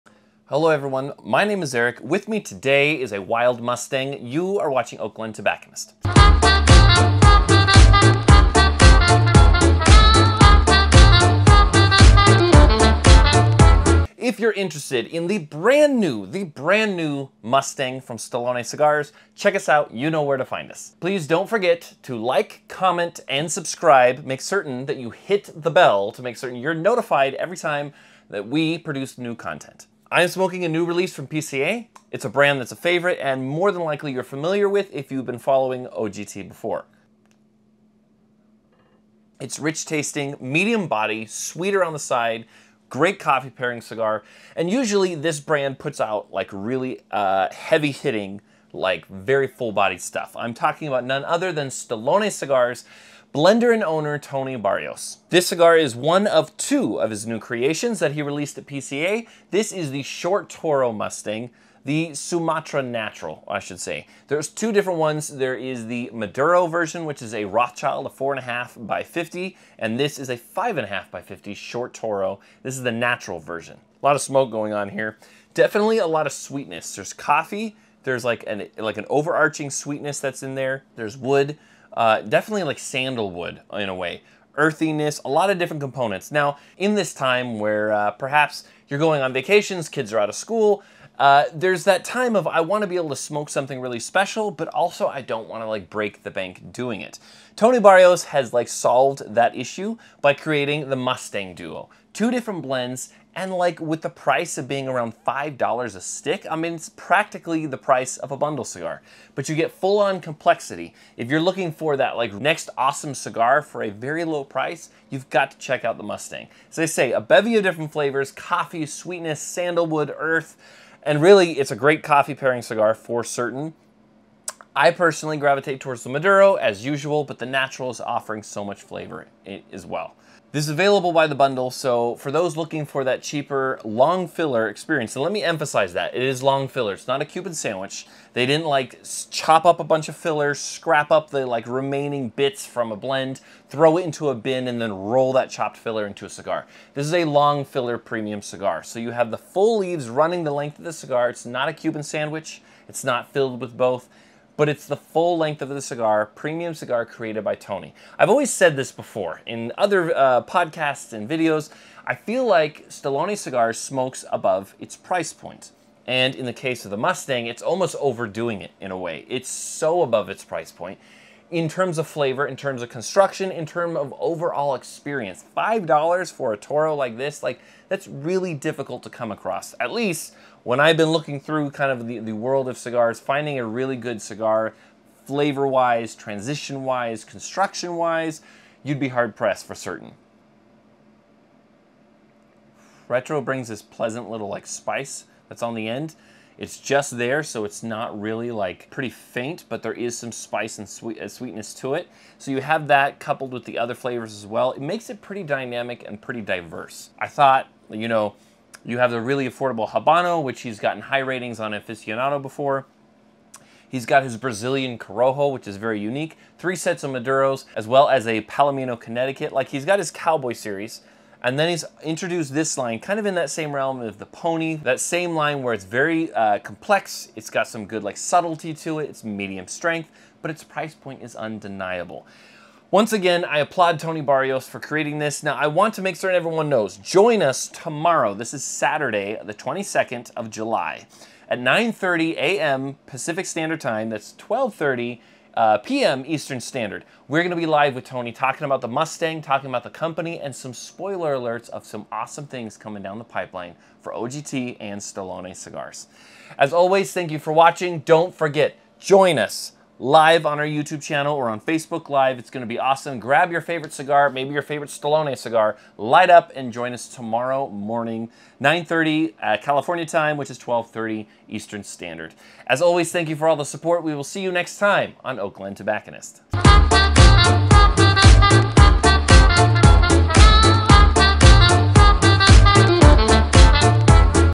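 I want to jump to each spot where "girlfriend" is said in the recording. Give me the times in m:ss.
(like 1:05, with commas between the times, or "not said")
not said.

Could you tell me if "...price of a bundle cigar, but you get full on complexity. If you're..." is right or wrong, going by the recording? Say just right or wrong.
right.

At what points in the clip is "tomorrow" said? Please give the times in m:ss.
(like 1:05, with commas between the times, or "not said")
3:57, 4:27.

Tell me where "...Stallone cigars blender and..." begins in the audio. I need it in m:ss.
0:51.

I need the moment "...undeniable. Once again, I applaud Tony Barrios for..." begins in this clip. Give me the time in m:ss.
3:51.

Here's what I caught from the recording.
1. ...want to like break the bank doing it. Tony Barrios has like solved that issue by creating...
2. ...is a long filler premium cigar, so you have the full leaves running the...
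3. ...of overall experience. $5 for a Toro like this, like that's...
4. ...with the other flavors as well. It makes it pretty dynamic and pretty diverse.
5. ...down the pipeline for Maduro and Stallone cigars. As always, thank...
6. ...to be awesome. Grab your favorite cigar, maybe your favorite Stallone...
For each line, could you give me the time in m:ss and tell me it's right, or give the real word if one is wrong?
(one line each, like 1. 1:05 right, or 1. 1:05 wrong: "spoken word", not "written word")
1. 1:35 right
2. 2:27 right
3. 2:53 right
4. 3:23 right
5. 4:13 wrong: "OGT", not "Maduro"
6. 4:22 right.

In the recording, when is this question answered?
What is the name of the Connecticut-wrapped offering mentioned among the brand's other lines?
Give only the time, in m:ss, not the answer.
3:38.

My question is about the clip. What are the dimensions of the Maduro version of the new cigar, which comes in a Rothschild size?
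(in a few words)
4 1/2 by 50.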